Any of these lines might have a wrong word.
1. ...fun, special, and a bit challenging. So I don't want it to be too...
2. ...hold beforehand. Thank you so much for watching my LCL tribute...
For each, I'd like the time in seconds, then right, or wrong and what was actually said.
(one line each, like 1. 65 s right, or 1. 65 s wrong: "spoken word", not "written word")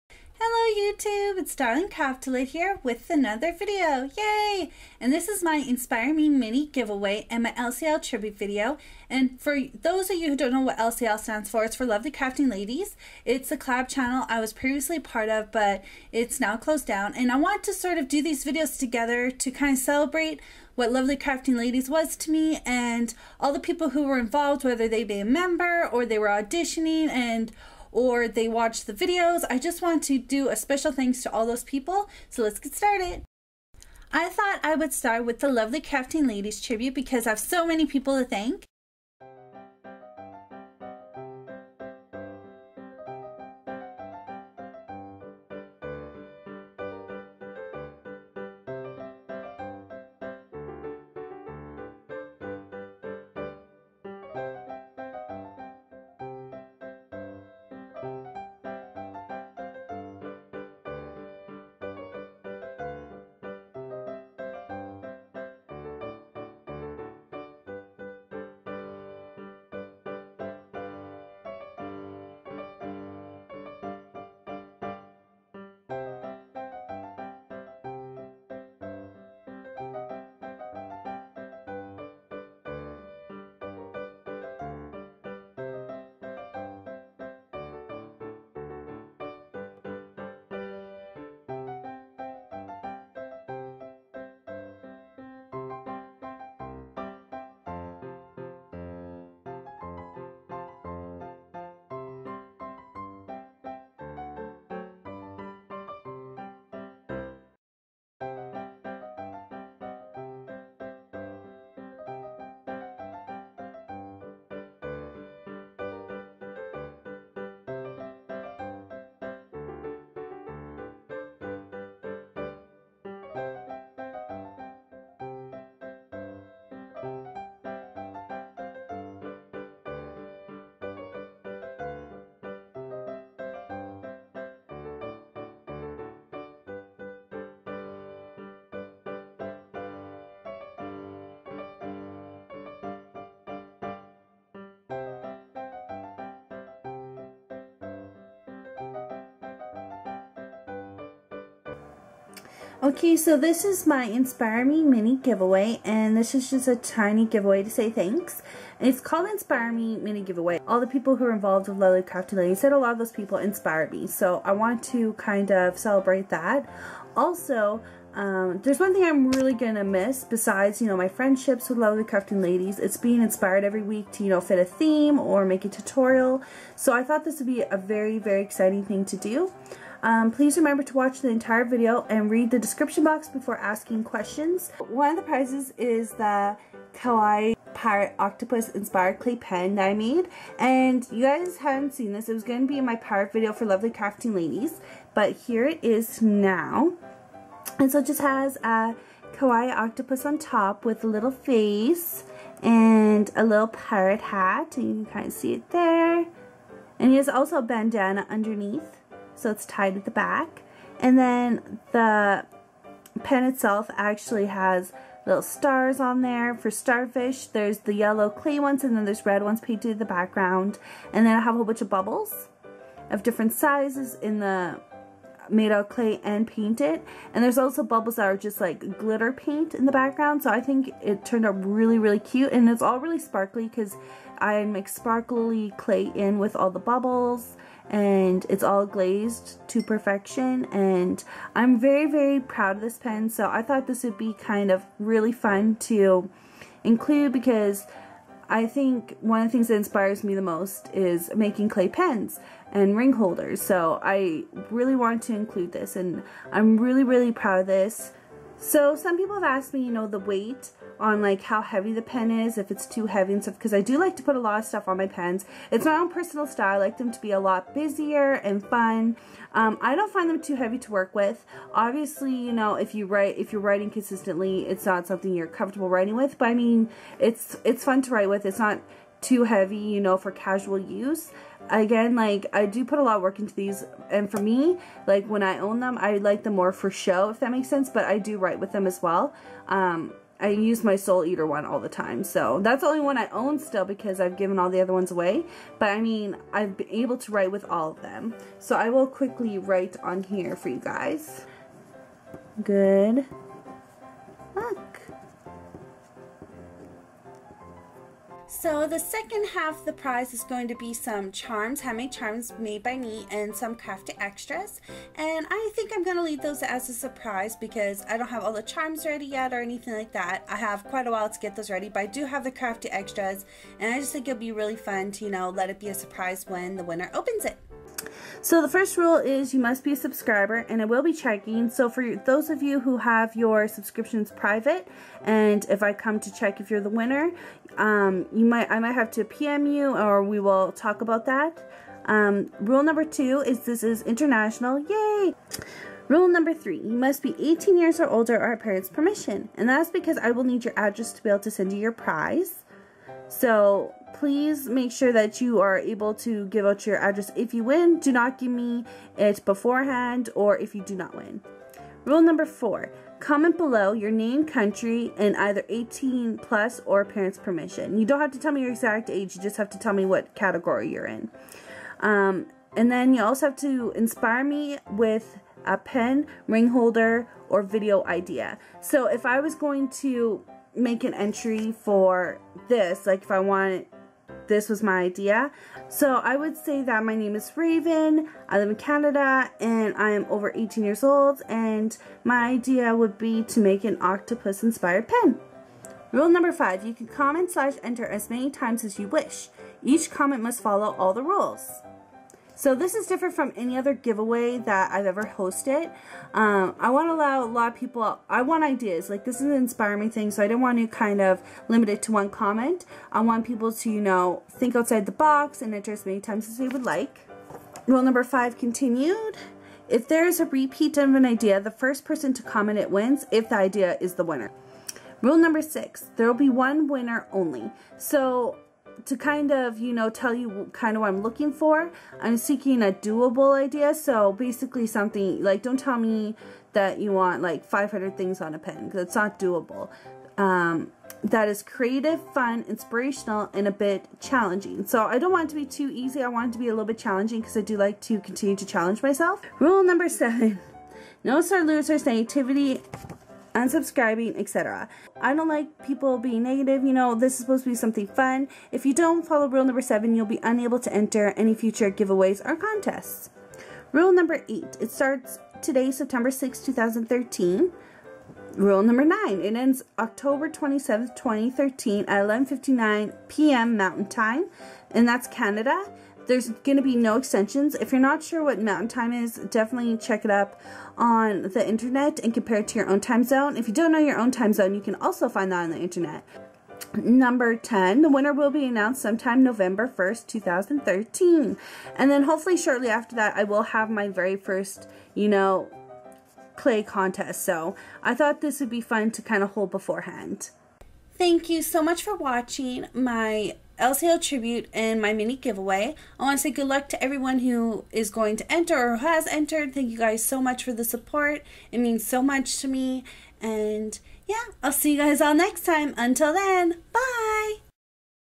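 1. 442 s wrong: "inspirational", not "special"
2. 499 s right.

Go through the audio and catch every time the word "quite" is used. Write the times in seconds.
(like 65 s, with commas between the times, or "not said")
320 s.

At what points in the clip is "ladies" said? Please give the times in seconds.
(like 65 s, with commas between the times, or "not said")
12 s, 21 s, 36 s, 162 s, 172 s, 194 s.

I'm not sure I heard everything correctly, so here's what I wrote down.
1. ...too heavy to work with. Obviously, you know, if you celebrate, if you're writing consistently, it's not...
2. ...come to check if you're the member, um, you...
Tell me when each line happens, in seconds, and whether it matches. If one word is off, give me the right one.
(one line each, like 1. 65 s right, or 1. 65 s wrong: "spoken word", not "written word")
1. 270 s wrong: "write", not "celebrate"
2. 335 s wrong: "winner", not "member".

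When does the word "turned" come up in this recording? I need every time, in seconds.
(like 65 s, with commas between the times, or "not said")
231 s.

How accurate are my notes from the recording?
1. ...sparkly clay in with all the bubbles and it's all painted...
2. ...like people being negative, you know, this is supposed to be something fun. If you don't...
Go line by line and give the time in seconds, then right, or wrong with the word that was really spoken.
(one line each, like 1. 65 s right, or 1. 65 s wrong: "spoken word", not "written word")
1. 234 s wrong: "glazed", not "painted"
2. 455 s right.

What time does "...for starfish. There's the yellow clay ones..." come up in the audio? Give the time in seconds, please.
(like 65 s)
216 s.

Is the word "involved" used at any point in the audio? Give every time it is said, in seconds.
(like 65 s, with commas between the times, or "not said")
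24 s, 161 s.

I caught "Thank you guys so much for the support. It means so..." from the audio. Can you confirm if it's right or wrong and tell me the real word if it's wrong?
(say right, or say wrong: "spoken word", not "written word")
right.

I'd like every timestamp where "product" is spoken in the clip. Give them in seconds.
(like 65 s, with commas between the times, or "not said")
not said.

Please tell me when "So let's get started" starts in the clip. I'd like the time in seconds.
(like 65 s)
32 s.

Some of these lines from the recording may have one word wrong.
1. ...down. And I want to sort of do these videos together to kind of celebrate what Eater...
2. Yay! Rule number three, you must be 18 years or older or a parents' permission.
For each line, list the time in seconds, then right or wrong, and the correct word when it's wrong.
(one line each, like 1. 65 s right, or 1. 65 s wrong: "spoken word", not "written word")
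1. 16 s wrong: "Lovely", not "Eater"
2. 344 s right.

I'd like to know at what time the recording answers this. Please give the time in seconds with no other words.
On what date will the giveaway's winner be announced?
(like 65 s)
489 s.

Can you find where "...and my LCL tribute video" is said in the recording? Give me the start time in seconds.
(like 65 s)
7 s.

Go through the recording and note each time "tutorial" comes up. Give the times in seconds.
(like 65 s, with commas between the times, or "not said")
175 s.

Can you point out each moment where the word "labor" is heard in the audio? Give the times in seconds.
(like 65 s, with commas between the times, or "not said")
not said.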